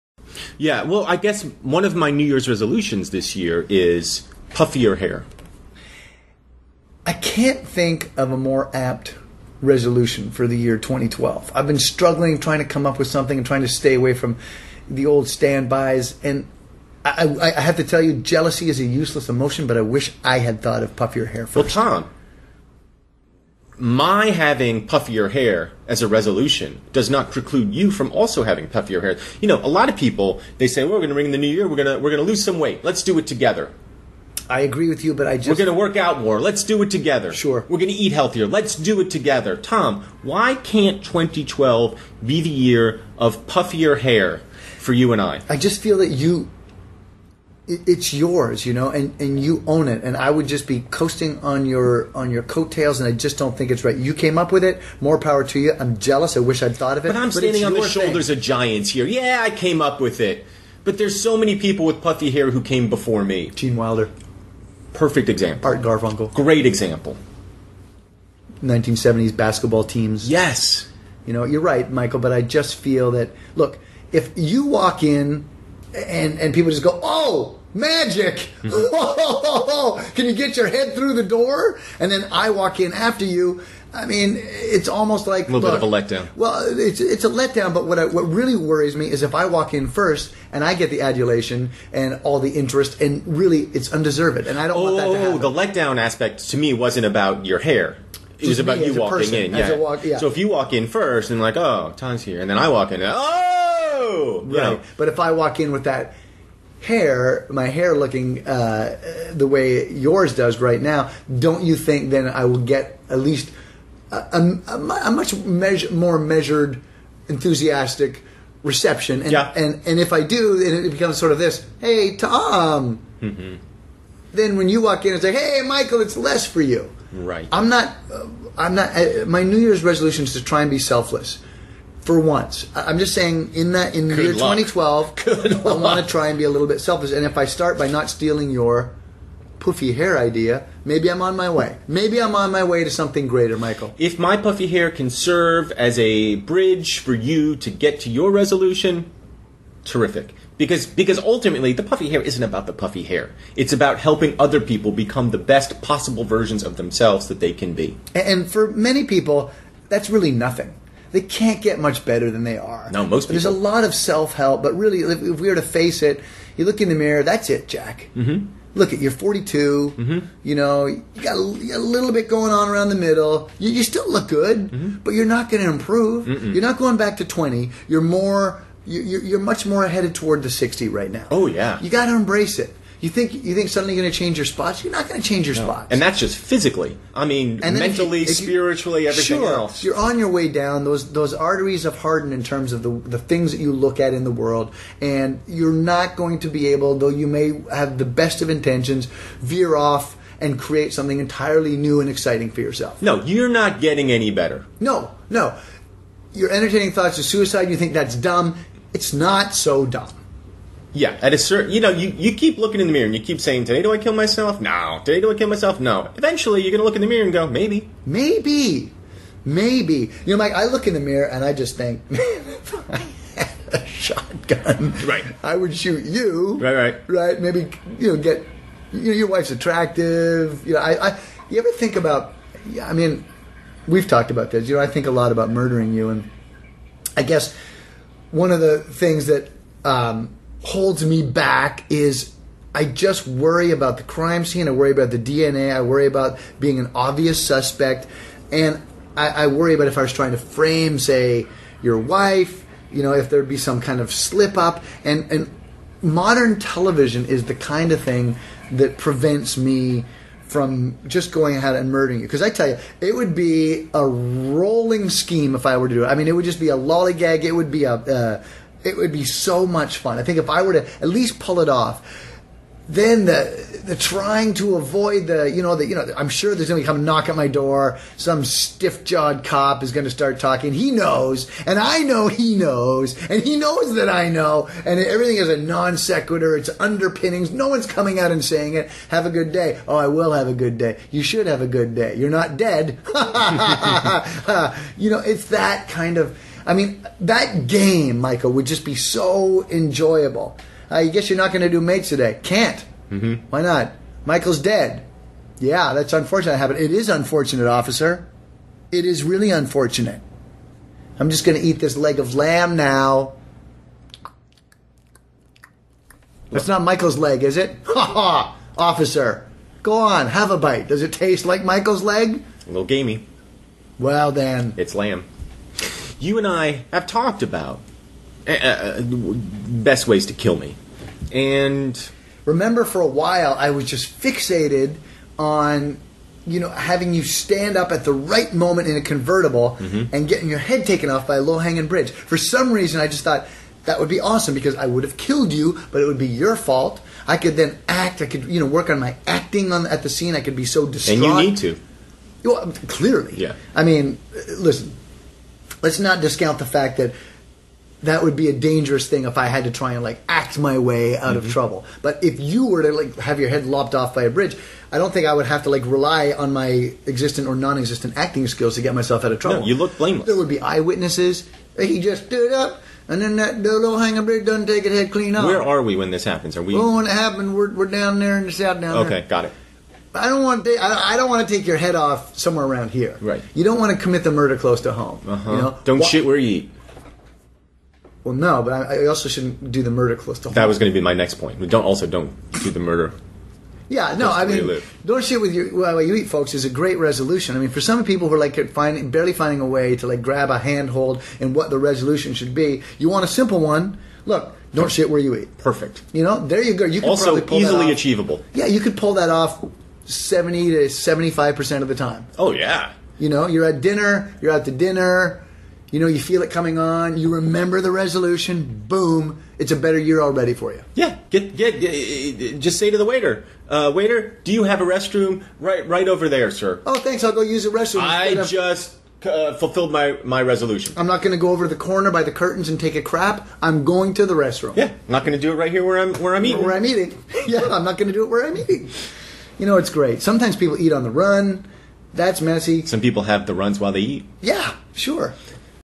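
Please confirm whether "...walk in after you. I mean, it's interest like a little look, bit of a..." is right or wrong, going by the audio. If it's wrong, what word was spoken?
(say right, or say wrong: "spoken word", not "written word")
wrong: "almost", not "interest".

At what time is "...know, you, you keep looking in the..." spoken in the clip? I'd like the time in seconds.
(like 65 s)
211 s.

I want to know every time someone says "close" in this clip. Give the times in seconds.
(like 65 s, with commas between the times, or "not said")
384 s, 390 s.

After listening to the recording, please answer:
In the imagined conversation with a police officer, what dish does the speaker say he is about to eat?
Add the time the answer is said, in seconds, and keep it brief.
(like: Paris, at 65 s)
Leg of lamb, at 311 s.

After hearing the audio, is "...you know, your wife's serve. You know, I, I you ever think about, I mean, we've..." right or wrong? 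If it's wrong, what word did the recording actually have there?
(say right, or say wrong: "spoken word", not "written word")
wrong: "attractive", not "serve".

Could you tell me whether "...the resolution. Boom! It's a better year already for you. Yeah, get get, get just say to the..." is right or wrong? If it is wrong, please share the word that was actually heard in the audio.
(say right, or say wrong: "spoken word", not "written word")
right.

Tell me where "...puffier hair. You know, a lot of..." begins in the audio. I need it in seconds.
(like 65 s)
28 s.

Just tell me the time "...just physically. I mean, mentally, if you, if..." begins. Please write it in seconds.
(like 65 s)
186 s.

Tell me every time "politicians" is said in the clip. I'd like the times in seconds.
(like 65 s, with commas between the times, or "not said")
not said.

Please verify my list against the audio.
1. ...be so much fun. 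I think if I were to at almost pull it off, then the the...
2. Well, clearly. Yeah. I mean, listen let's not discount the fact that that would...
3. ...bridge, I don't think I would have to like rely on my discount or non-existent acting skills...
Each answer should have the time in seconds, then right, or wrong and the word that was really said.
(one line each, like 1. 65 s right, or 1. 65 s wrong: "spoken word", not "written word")
1. 269 s wrong: "least", not "almost"
2. 352 s right
3. 364 s wrong: "existent", not "discount".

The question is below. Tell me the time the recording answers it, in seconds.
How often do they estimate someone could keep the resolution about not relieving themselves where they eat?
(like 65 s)
410 s.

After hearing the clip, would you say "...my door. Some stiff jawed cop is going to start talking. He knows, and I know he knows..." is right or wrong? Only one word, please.
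right.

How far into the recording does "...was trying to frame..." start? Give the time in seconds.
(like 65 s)
250 s.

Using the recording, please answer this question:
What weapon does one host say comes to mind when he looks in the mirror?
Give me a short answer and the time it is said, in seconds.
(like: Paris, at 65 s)
Shotgun, at 223 s.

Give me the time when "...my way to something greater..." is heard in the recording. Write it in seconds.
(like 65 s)
142 s.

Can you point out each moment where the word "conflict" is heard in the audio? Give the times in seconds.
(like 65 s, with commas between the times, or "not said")
not said.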